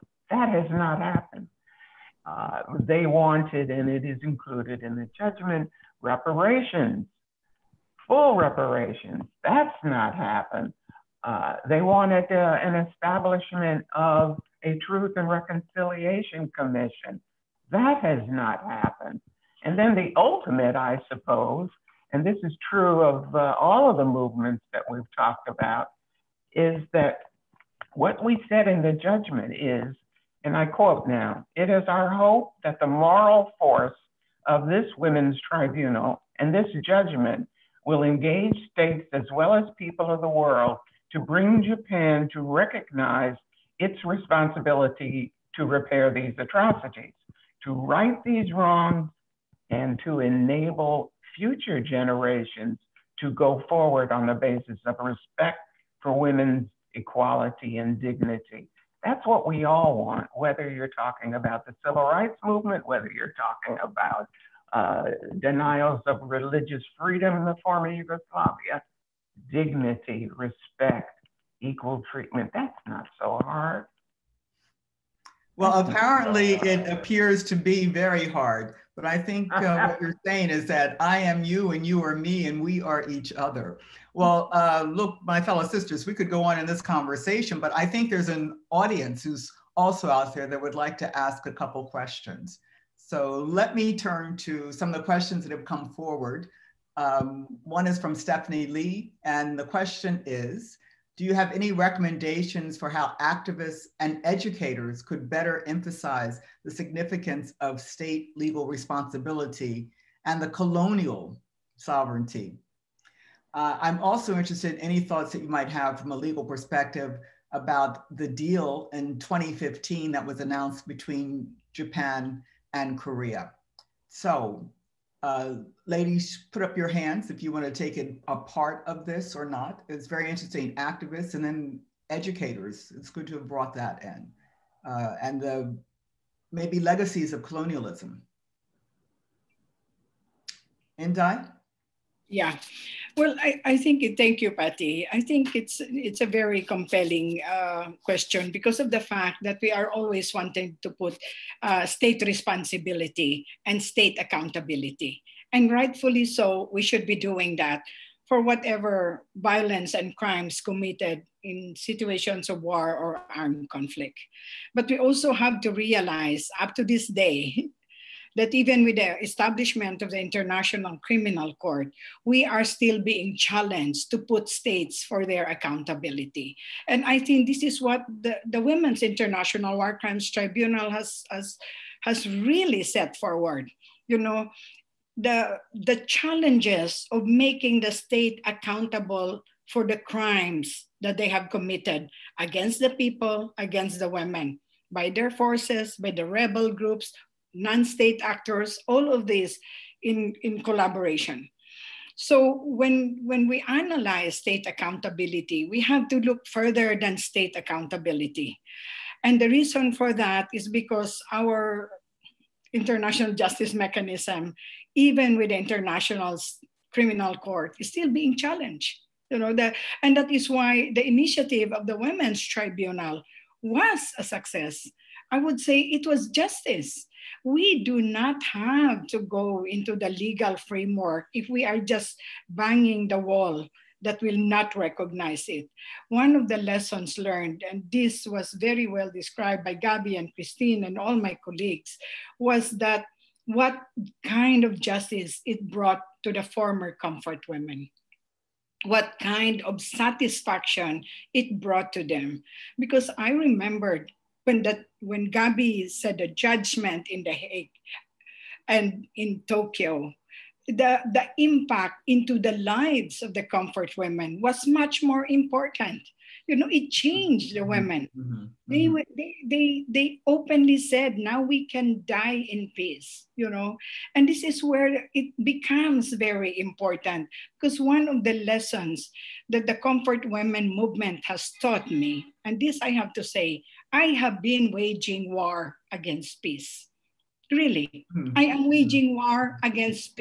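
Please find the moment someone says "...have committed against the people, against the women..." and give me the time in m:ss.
3:11.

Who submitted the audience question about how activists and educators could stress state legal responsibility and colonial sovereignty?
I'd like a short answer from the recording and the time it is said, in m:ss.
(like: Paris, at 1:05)
Stephanie Lee, at 1:38.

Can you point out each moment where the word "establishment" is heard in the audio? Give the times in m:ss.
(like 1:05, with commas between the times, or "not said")
0:12, 2:49.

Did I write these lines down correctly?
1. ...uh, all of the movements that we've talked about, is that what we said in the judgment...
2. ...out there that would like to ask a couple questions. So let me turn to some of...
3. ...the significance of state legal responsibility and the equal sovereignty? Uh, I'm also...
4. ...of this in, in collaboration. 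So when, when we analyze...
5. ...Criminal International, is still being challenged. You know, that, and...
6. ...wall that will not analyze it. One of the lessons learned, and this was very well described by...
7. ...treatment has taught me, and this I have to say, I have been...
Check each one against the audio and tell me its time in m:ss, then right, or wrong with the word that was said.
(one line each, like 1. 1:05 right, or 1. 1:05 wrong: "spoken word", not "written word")
1. 0:23 right
2. 1:30 right
3. 1:46 wrong: "colonial", not "equal"
4. 3:19 right
5. 3:36 wrong: "Court", not "International"
6. 3:53 wrong: "recognize", not "analyze"
7. 4:40 wrong: "movement", not "treatment".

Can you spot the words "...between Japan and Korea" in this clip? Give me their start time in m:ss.
2:00.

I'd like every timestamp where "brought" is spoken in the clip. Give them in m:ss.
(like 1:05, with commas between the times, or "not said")
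2:13, 4:05, 4:11.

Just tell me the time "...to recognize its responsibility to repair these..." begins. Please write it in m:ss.
0:42.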